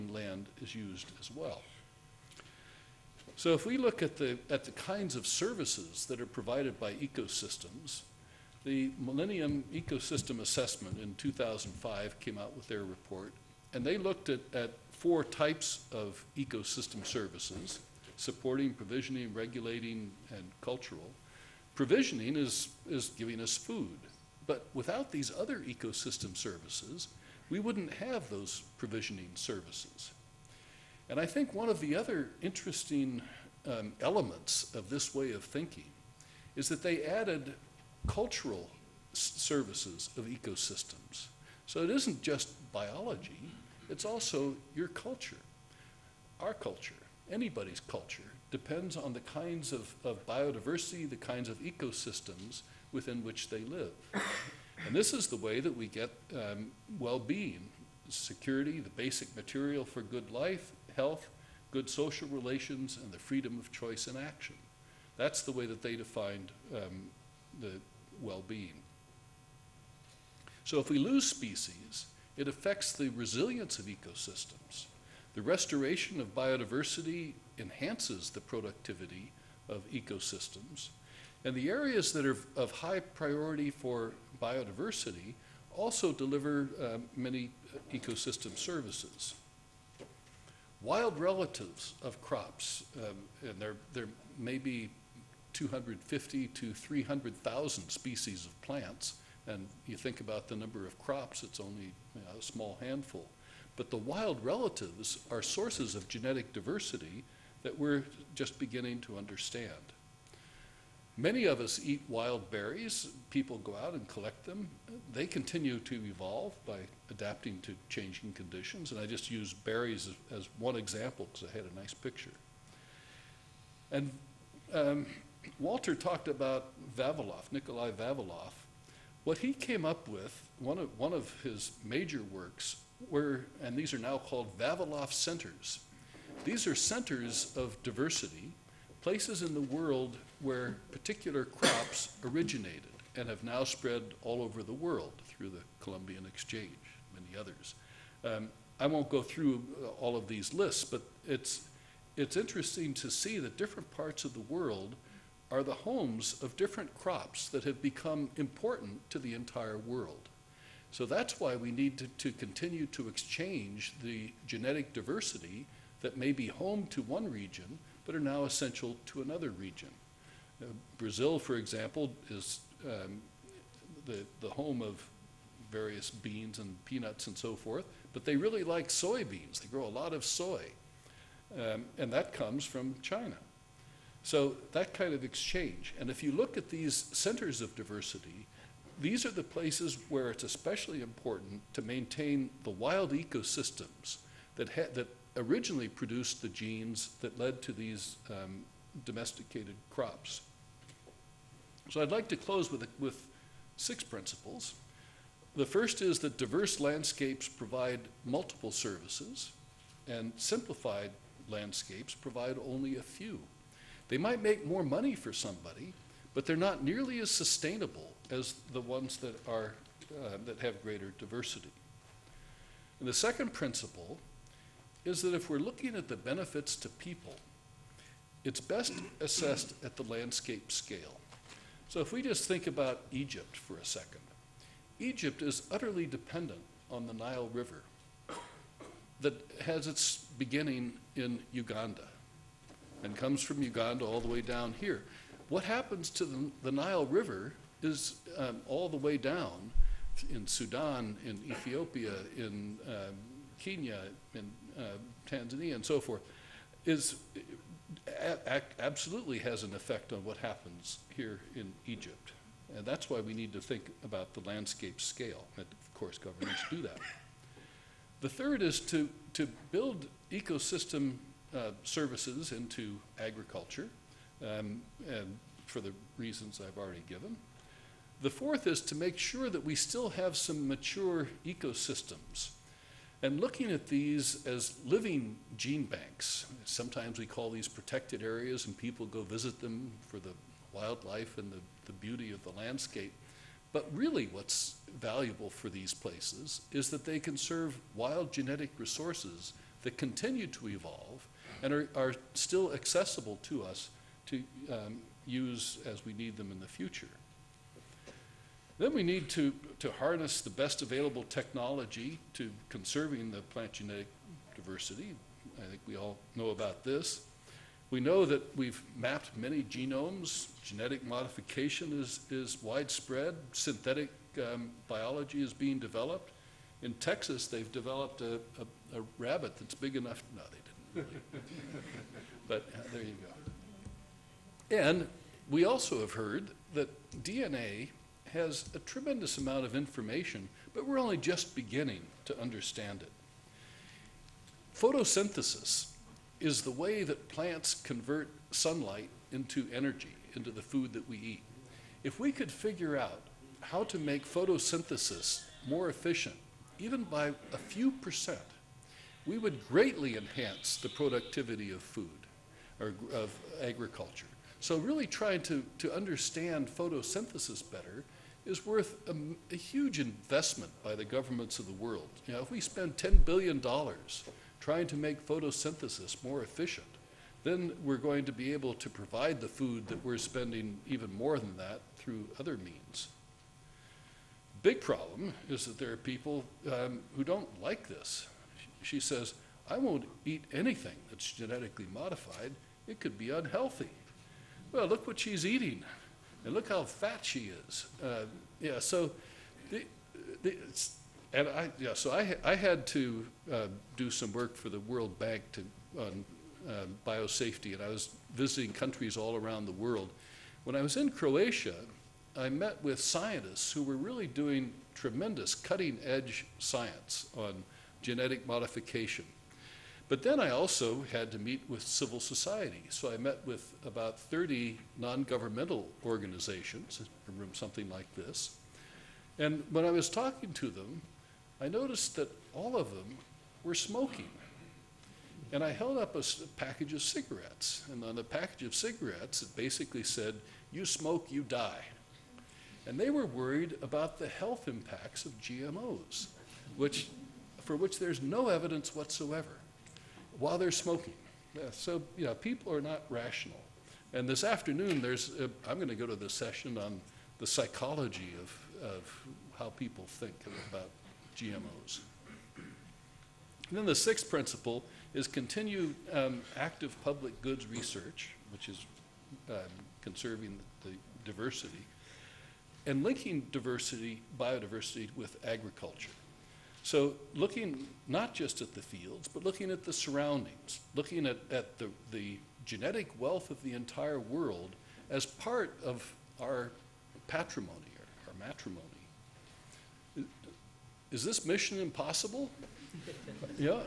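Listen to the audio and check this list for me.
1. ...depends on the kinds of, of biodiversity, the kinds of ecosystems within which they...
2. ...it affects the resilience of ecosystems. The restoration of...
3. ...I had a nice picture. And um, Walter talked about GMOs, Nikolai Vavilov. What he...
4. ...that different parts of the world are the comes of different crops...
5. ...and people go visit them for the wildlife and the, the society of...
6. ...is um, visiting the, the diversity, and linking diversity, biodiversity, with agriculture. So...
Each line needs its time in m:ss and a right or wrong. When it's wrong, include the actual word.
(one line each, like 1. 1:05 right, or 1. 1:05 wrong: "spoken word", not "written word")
1. 0:48 right
2. 1:12 right
3. 2:01 wrong: "Vavilov", not "GMOs"
4. 2:33 wrong: "homes", not "comes"
5. 4:48 wrong: "beauty", not "society"
6. 7:48 wrong: "conserving", not "visiting".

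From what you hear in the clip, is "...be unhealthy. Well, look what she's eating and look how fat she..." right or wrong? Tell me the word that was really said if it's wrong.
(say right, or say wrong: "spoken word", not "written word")
right.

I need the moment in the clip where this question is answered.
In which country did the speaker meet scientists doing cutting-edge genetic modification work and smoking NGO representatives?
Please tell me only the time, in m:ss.
6:51.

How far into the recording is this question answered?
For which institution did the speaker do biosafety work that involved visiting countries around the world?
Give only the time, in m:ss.
6:44.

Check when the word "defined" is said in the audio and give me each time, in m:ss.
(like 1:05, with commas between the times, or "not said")
1:05.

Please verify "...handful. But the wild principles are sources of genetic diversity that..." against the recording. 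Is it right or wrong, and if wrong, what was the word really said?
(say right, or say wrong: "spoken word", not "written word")
wrong: "relatives", not "principles".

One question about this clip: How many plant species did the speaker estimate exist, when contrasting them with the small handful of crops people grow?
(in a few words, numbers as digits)
250,000 to 300,000.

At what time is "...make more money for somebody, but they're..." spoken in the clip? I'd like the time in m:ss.
3:34.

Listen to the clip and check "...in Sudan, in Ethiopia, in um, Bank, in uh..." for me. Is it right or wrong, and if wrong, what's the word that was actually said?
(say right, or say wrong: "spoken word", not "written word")
wrong: "Kenya", not "Bank".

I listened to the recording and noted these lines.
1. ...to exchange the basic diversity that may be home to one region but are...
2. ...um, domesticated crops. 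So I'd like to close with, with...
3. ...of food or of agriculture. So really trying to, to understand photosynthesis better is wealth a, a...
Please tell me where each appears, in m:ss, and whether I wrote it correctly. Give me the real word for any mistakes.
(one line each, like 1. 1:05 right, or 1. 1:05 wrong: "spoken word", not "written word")
1. 2:42 wrong: "genetic", not "basic"
2. 3:18 right
3. 6:01 wrong: "worth", not "wealth".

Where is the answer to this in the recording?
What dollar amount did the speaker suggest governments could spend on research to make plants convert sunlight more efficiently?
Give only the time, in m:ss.
6:12.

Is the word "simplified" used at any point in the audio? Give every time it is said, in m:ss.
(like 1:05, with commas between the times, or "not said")
3:30.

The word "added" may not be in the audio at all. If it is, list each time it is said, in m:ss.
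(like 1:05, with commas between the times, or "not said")
0:37.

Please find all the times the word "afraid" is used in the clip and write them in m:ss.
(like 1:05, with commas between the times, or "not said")
not said.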